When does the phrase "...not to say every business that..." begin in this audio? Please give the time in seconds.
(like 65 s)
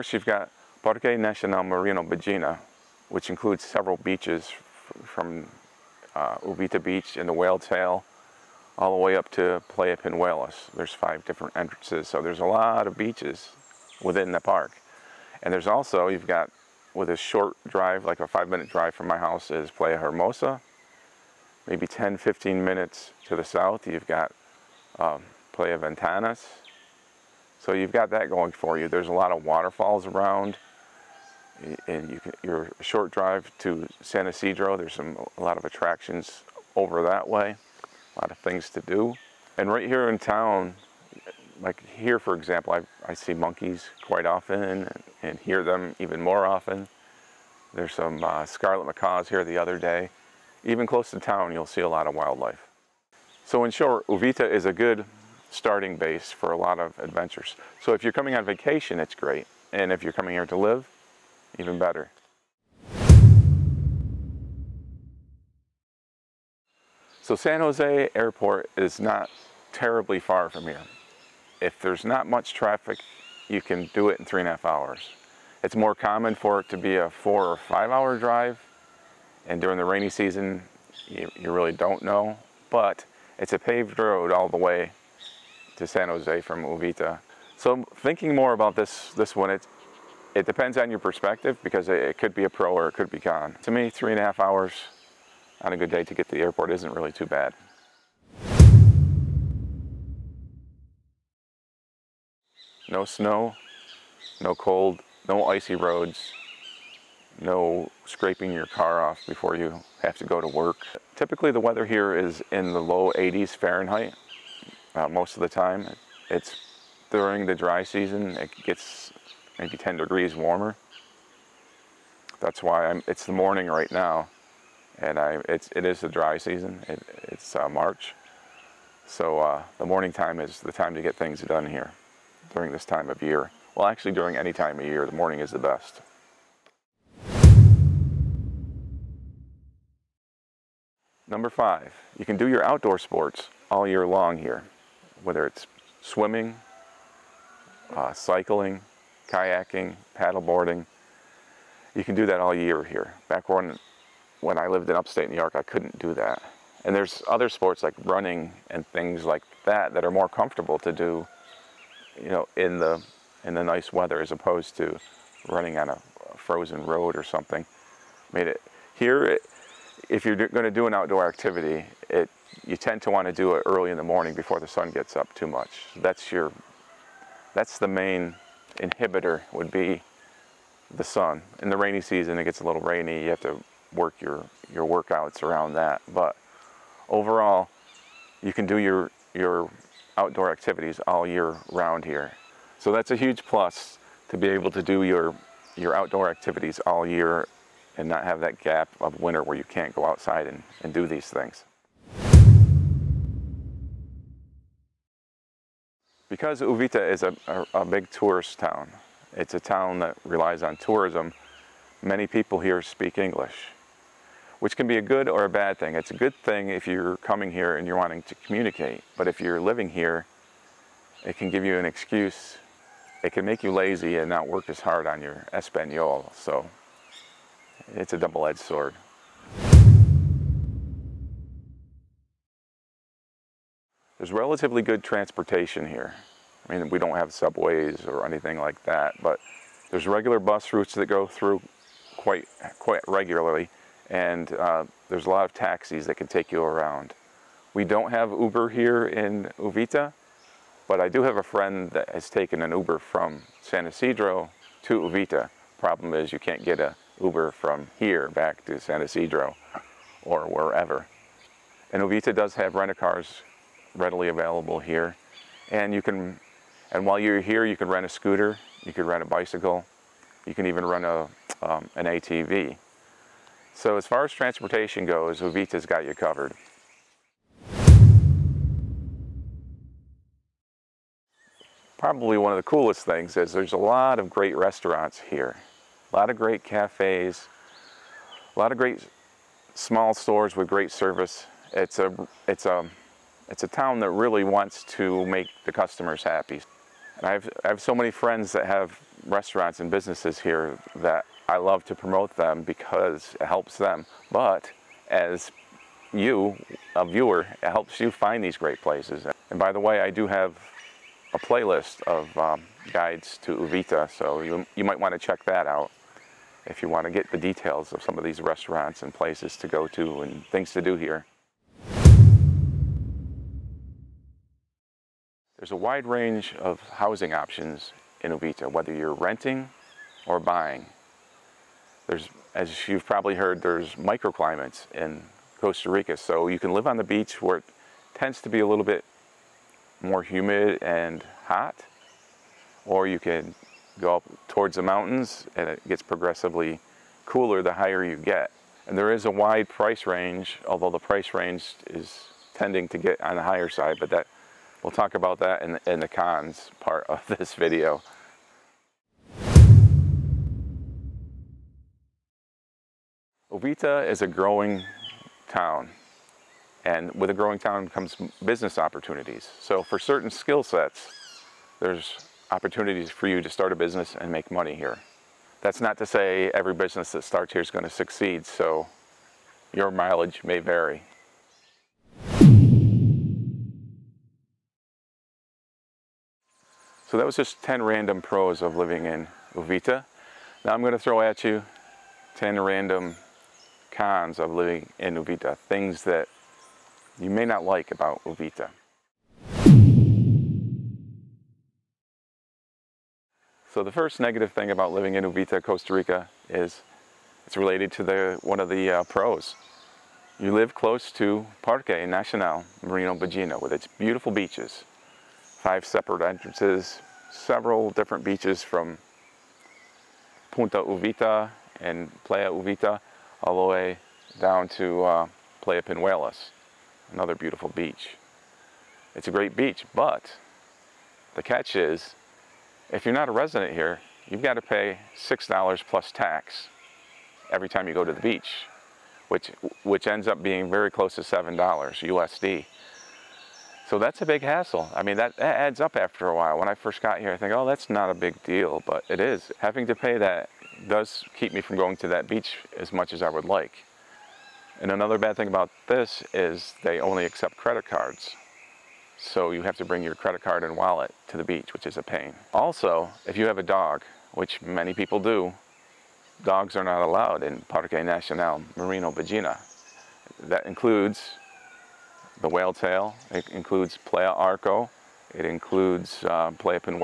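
375 s.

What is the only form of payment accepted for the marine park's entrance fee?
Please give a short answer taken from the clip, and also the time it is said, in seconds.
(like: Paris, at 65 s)
credit cards, at 457 s.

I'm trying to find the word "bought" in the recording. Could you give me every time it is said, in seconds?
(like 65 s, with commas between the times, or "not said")
not said.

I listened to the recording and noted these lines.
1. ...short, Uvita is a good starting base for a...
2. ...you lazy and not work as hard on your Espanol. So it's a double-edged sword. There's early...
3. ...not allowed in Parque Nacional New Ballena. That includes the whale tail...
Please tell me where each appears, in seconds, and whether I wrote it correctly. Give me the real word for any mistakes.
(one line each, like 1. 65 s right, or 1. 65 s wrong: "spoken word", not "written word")
1. 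53 s right
2. 223 s wrong: "relatively", not "early"
3. 466 s wrong: "Marino", not "New".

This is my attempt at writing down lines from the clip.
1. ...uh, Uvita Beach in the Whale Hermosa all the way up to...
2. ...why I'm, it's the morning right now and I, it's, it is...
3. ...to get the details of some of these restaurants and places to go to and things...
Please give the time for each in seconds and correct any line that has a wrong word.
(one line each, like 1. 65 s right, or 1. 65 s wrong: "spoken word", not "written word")
1. 6 s wrong: "Tail", not "Hermosa"
2. 122 s right
3. 317 s right.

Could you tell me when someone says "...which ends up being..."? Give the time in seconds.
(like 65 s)
439 s.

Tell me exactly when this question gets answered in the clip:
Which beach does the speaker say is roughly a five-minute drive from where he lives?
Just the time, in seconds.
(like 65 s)
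19 s.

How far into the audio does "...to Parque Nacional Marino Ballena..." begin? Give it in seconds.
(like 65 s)
411 s.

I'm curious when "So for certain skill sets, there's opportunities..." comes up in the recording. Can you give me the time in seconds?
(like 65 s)
369 s.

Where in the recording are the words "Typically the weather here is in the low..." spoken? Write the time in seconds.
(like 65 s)
111 s.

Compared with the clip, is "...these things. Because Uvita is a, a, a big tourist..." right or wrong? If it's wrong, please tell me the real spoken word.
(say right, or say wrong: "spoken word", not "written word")
right.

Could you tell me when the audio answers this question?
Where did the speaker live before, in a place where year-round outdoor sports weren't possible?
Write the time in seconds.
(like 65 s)
154 s.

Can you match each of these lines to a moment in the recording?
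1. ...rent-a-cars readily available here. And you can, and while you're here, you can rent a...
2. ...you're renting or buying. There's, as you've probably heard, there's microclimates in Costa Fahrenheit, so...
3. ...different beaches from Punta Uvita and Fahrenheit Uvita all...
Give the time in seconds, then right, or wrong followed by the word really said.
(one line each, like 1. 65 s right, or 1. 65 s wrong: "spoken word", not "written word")
1. 262 s right
2. 328 s wrong: "Rica", not "Fahrenheit"
3. 417 s wrong: "Playa", not "Fahrenheit".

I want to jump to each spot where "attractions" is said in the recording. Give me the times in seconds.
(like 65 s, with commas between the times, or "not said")
35 s.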